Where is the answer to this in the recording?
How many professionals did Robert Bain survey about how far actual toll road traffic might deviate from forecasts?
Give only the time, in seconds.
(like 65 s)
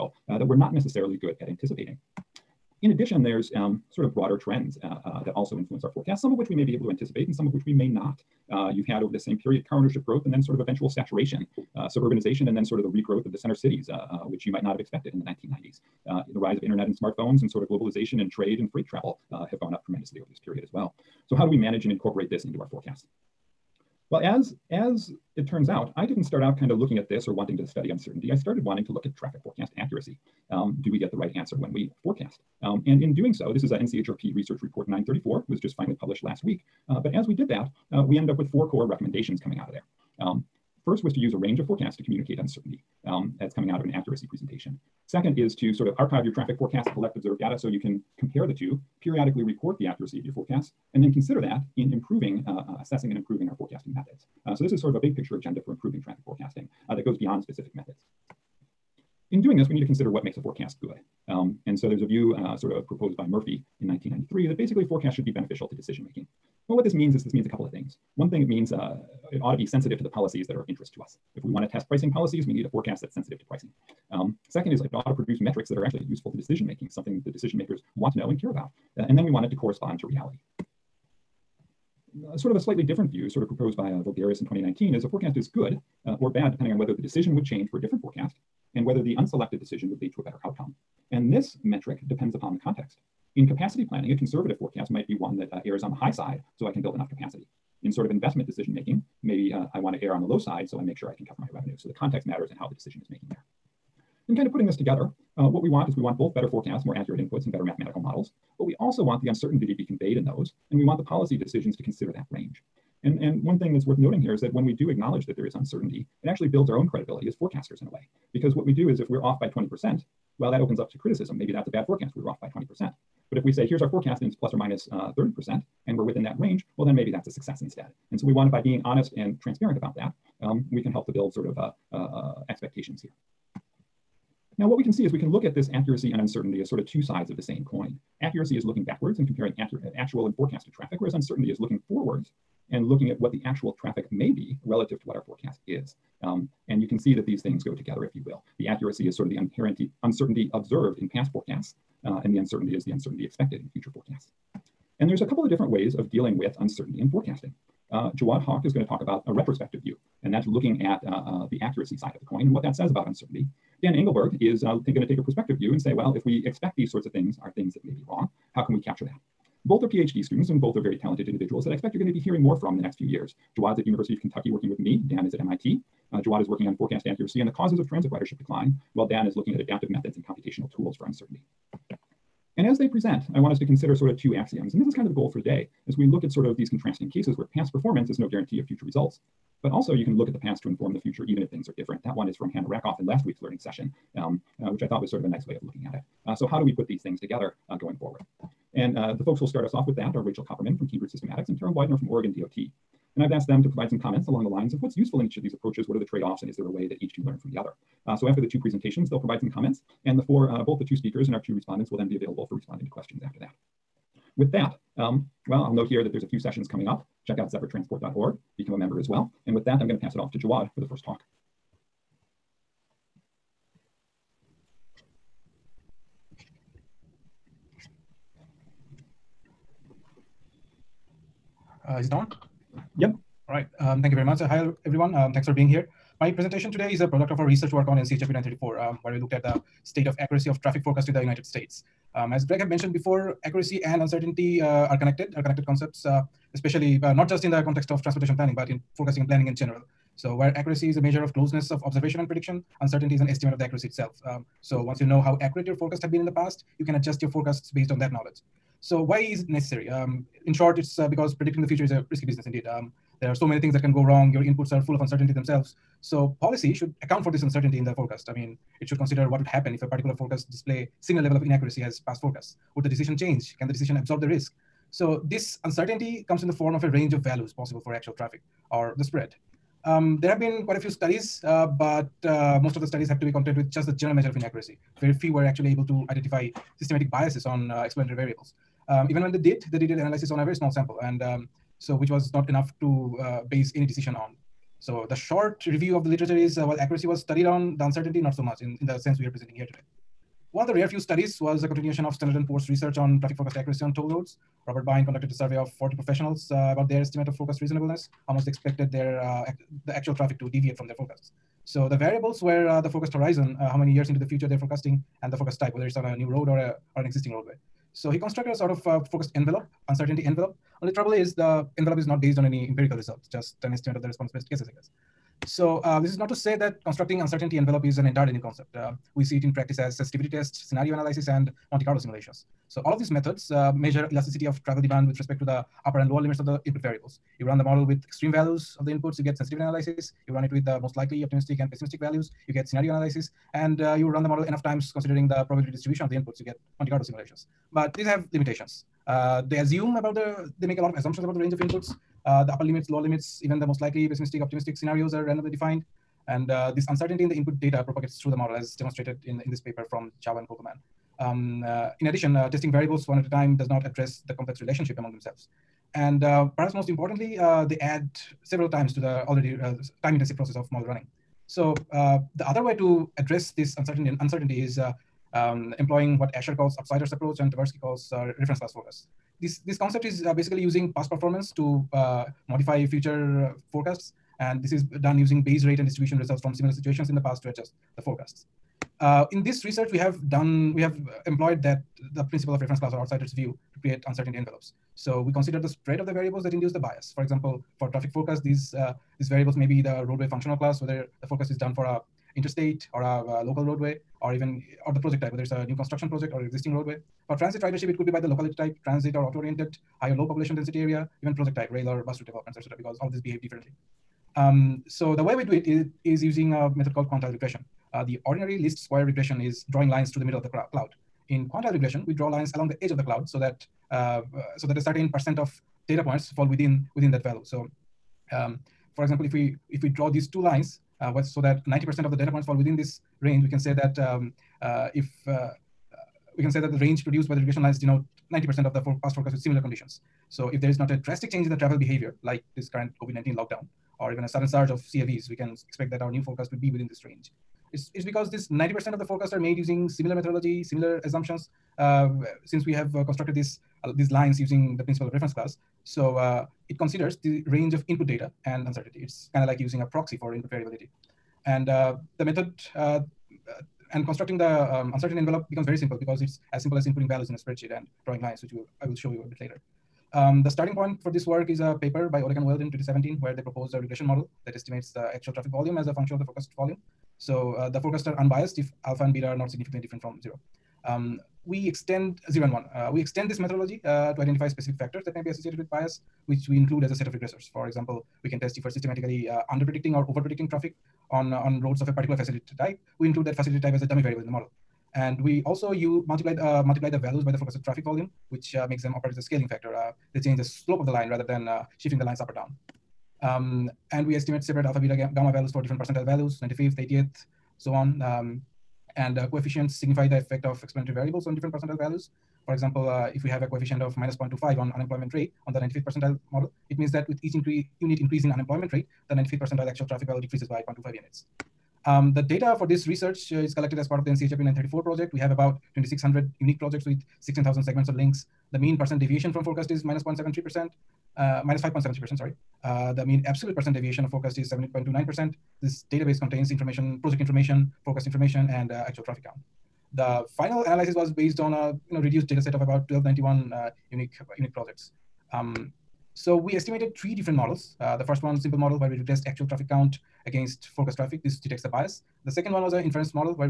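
305 s.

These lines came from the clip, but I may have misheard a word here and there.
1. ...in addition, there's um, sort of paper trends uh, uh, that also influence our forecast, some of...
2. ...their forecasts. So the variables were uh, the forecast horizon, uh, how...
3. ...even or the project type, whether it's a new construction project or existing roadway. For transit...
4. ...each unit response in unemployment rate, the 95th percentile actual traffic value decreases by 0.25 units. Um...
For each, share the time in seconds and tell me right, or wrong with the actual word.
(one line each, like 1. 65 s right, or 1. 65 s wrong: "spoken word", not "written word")
1. 2 s wrong: "broader", not "paper"
2. 310 s right
3. 404 s right
4. 517 s wrong: "increase", not "response".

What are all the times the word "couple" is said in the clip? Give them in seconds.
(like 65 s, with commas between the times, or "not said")
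67 s, 155 s.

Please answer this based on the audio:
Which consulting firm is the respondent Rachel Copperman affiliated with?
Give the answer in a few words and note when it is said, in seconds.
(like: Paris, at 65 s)
Cambridge Systematics, at 200 s.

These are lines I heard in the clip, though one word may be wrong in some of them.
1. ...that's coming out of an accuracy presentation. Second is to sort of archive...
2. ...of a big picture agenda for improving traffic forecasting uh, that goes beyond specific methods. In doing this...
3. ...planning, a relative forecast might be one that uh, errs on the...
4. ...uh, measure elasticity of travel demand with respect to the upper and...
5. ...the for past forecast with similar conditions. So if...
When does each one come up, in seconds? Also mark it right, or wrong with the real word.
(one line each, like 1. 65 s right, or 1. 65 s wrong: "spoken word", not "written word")
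1. 43 s right
2. 54 s right
3. 93 s wrong: "conservative", not "relative"
4. 333 s right
5. 438 s right.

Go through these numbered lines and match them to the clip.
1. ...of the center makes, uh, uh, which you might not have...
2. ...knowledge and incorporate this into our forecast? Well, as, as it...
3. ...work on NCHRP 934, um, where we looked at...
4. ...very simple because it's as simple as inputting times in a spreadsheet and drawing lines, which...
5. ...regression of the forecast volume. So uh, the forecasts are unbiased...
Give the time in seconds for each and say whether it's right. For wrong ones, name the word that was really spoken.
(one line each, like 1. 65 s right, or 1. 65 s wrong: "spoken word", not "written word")
1. 13 s wrong: "cities", not "makes"
2. 21 s wrong: "manage", not "knowledge"
3. 237 s right
4. 465 s wrong: "values", not "times"
5. 475 s wrong: "function", not "regression".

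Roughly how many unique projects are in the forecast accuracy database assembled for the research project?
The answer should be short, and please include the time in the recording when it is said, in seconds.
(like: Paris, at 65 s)
2,600, at 525 s.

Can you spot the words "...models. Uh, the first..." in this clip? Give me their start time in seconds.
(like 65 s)
547 s.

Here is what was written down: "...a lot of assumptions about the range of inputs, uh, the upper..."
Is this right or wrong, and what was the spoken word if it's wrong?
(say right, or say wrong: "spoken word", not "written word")
right.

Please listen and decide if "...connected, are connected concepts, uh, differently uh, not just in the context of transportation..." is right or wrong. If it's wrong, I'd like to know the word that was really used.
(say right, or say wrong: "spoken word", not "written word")
wrong: "especially", not "differently".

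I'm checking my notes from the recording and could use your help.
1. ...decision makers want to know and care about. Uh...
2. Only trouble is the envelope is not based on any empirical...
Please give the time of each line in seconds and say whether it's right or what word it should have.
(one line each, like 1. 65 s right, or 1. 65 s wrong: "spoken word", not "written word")
1. 77 s right
2. 320 s right.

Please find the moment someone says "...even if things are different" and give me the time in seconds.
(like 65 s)
191 s.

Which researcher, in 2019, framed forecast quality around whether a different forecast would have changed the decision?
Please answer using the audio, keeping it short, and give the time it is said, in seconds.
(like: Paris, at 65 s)
Voulgaris, at 84 s.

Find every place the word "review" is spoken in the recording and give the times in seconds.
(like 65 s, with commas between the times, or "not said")
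295 s.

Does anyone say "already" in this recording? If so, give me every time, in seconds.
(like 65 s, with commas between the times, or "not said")
369 s.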